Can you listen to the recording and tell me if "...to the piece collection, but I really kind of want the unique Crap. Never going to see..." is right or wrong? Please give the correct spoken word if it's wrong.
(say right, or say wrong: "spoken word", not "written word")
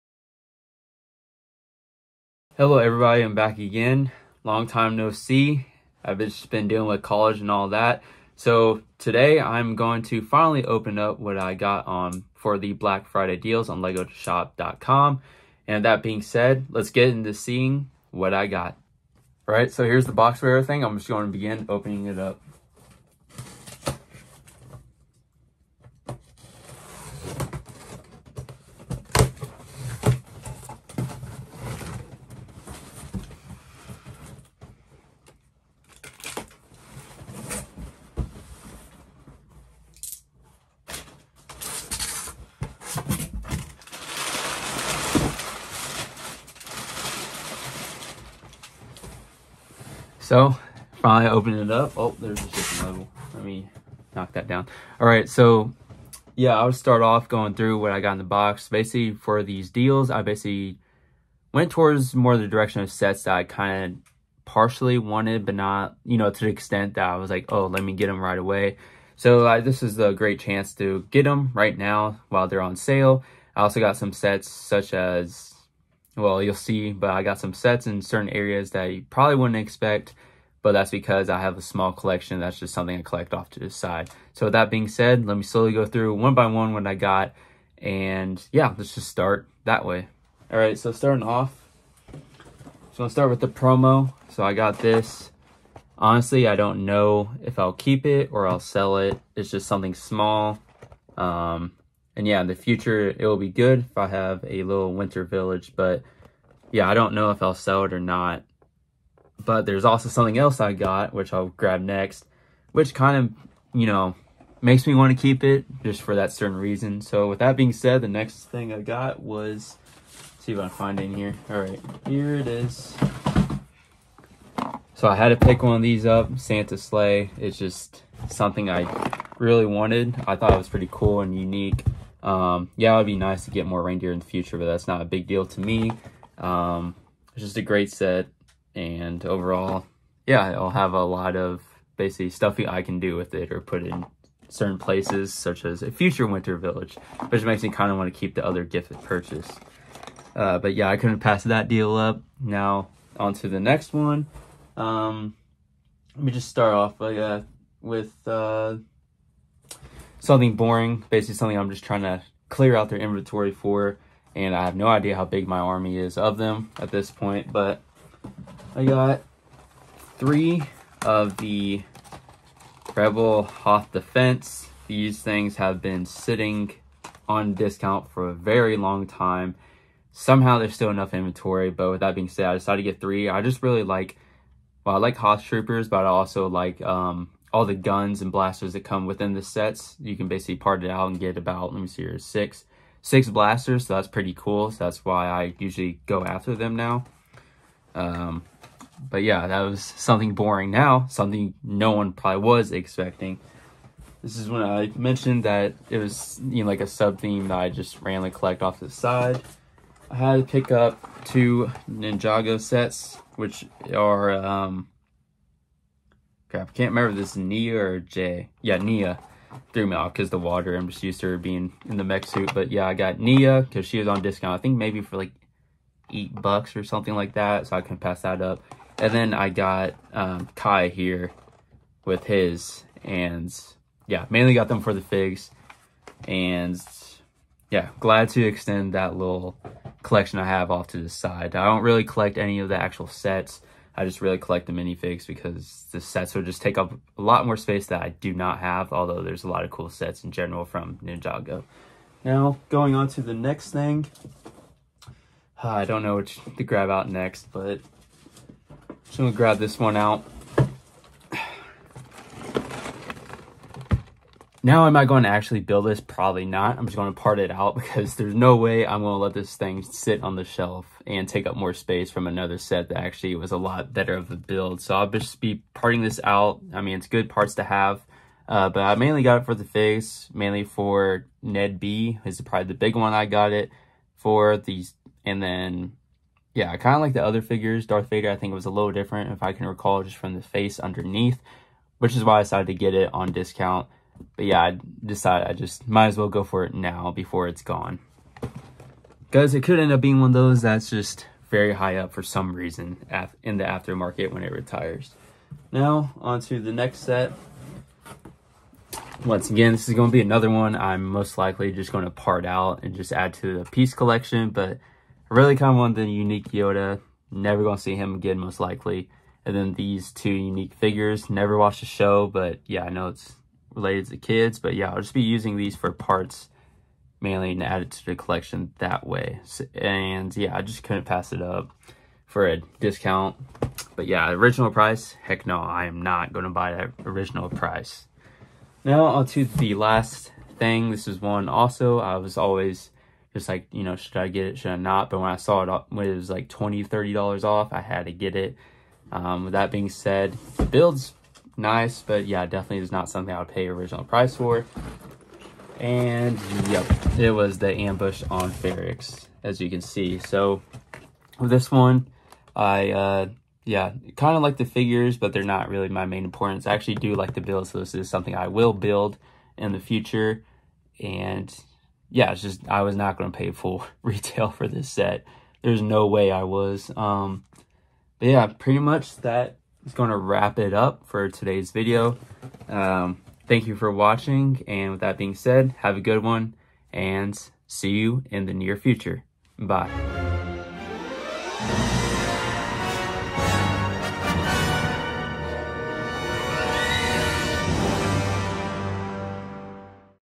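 wrong: "Yoda", not "Crap".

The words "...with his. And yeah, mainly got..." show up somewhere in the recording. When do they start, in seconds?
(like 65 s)
232 s.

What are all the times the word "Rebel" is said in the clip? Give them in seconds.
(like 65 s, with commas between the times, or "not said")
172 s.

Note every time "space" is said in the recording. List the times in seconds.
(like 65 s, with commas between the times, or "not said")
247 s, 271 s.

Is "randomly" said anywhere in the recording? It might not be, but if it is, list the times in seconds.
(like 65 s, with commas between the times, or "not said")
208 s.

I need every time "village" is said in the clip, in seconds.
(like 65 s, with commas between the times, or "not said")
105 s, 146 s.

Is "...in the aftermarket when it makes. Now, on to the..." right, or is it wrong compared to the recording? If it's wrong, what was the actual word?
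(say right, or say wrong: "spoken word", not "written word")
wrong: "retires", not "makes".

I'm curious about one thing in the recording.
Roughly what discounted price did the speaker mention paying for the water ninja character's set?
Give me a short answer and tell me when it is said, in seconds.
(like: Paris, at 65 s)
8 dollars, at 226 s.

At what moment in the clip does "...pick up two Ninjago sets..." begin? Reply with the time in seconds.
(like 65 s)
210 s.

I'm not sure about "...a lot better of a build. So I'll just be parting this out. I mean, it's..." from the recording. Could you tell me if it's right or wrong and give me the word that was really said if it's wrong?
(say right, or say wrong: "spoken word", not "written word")
right.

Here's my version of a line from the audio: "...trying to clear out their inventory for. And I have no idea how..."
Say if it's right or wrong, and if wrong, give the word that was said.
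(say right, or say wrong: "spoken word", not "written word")
right.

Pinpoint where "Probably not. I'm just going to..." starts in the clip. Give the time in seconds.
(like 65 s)
265 s.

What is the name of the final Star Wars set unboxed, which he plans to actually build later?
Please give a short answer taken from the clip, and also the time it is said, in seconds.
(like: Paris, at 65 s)
Ambush on Ferrix, at 357 s.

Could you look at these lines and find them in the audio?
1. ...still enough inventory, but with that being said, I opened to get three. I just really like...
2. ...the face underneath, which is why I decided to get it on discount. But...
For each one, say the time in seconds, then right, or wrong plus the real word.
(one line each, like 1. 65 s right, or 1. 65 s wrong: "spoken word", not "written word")
1. 180 s wrong: "decided", not "opened"
2. 290 s right.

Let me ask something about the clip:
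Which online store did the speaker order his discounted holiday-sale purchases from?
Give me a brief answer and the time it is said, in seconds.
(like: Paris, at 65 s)
legoshop.com, at 13 s.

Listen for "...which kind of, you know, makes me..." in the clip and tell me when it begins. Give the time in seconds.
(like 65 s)
112 s.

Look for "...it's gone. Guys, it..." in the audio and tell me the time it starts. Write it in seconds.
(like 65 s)
297 s.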